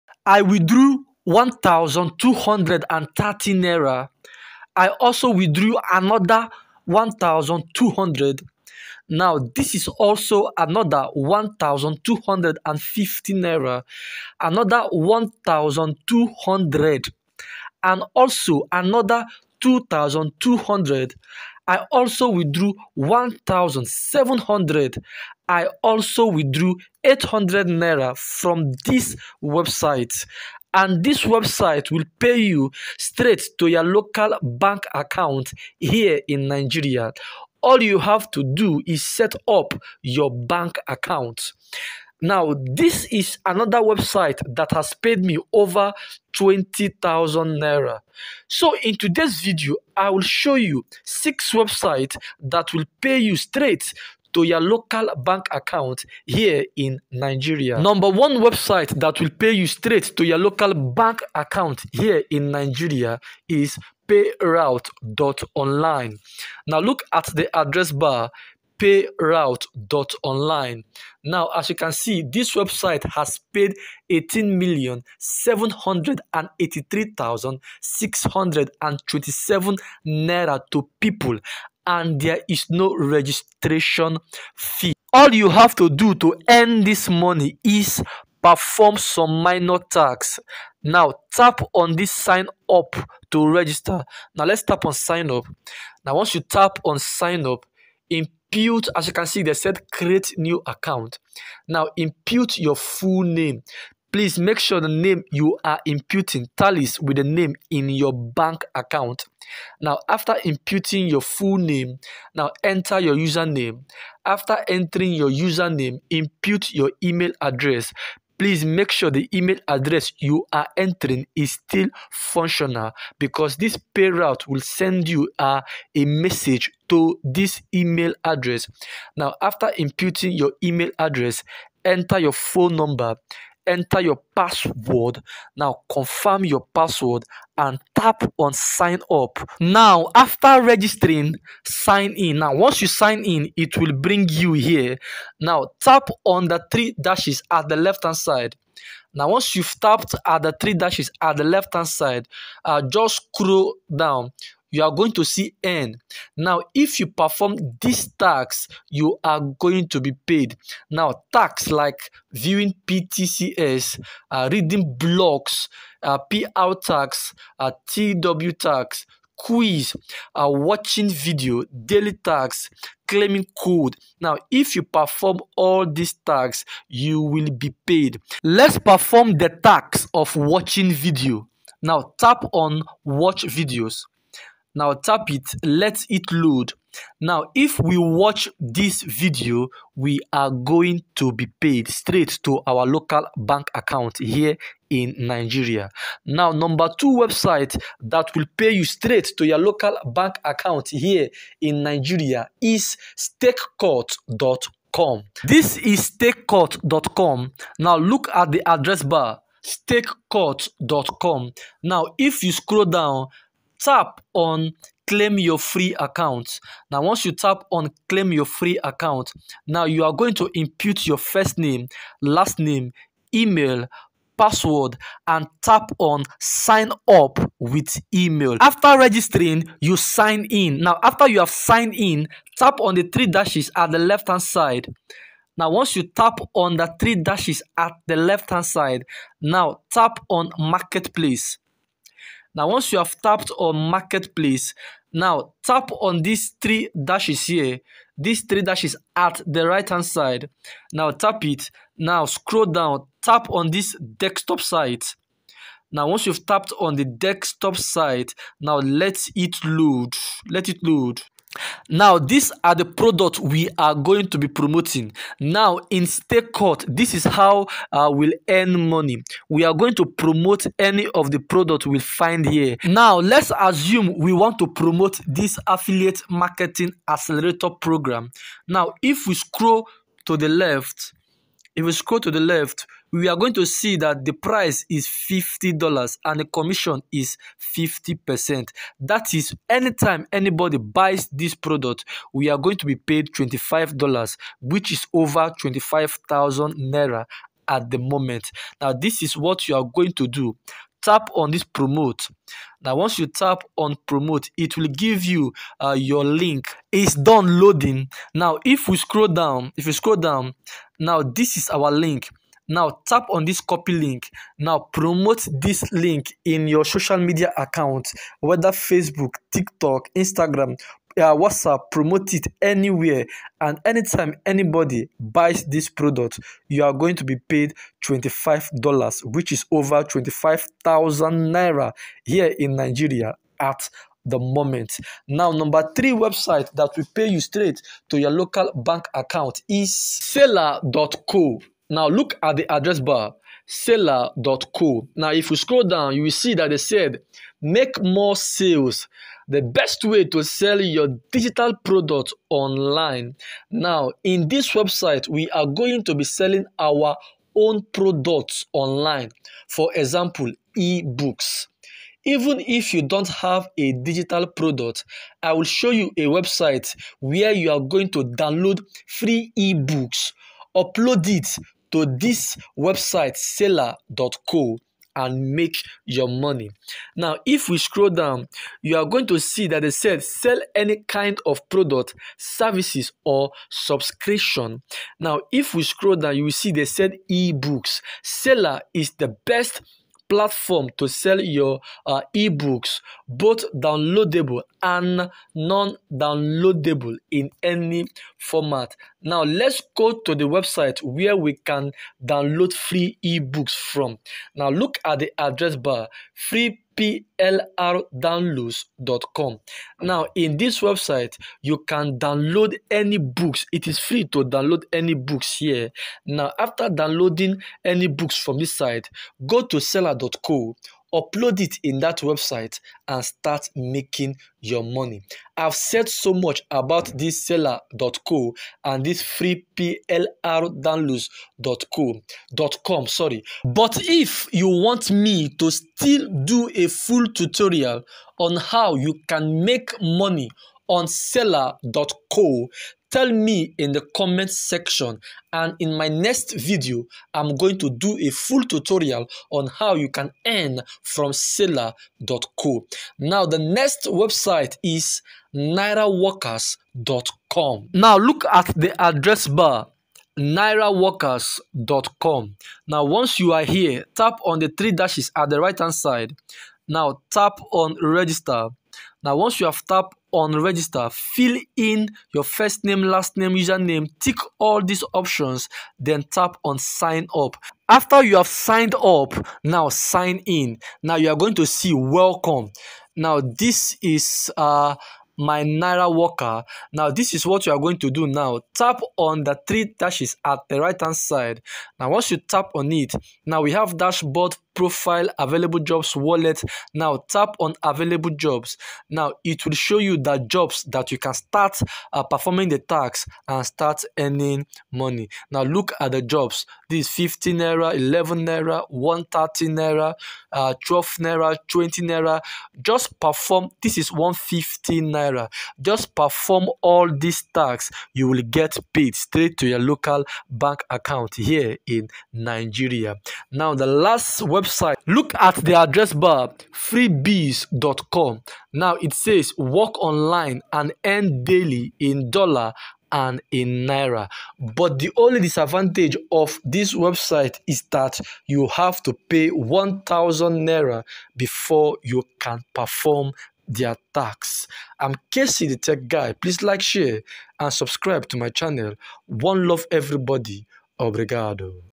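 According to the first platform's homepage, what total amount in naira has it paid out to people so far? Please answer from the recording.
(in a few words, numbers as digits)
18,783,627 naira.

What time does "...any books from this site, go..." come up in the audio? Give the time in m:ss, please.
6:57.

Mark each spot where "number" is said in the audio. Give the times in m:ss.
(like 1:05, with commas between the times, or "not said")
0:57, 2:12, 3:16, 5:35.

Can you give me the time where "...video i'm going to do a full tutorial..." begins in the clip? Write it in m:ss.
7:26.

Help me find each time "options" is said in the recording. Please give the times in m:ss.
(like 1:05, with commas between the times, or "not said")
7:55.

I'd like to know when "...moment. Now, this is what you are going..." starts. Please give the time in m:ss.
4:57.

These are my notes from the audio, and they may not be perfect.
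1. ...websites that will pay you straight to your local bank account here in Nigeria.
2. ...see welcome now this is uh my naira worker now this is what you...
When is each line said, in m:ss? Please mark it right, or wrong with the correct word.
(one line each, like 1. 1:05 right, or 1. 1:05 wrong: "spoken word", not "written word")
1. 0:51 right
2. 8:01 right.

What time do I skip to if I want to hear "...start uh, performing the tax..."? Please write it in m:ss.
8:21.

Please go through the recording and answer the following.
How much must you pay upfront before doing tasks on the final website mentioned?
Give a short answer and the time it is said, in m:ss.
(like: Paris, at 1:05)
1000 naira, at 8:59.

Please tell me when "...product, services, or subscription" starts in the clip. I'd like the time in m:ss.
6:21.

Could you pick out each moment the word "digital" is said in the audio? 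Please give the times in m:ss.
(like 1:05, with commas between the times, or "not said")
5:51, 6:03.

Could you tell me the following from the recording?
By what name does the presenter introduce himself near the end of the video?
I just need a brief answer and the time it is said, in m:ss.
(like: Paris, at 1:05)
KC the Tech Guy, at 9:05.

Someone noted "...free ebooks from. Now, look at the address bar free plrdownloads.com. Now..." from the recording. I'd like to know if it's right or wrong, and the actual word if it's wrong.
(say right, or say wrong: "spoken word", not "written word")
right.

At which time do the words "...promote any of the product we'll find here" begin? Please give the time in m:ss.
4:30.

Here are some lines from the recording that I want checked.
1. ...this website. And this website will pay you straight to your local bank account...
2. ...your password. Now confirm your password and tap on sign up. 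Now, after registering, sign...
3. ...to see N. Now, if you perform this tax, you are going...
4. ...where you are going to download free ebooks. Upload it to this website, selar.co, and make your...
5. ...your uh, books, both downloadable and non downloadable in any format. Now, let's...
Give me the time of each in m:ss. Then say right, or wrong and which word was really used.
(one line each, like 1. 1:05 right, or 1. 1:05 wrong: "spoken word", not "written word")
1. 0:28 right
2. 2:14 right
3. 2:35 right
4. 6:07 right
5. 6:31 wrong: "ebooks", not "books".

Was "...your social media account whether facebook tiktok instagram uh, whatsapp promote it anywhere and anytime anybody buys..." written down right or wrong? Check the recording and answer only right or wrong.
right.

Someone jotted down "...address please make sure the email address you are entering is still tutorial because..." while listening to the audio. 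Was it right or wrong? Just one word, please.
wrong.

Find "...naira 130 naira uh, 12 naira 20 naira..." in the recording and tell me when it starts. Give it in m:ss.
8:28.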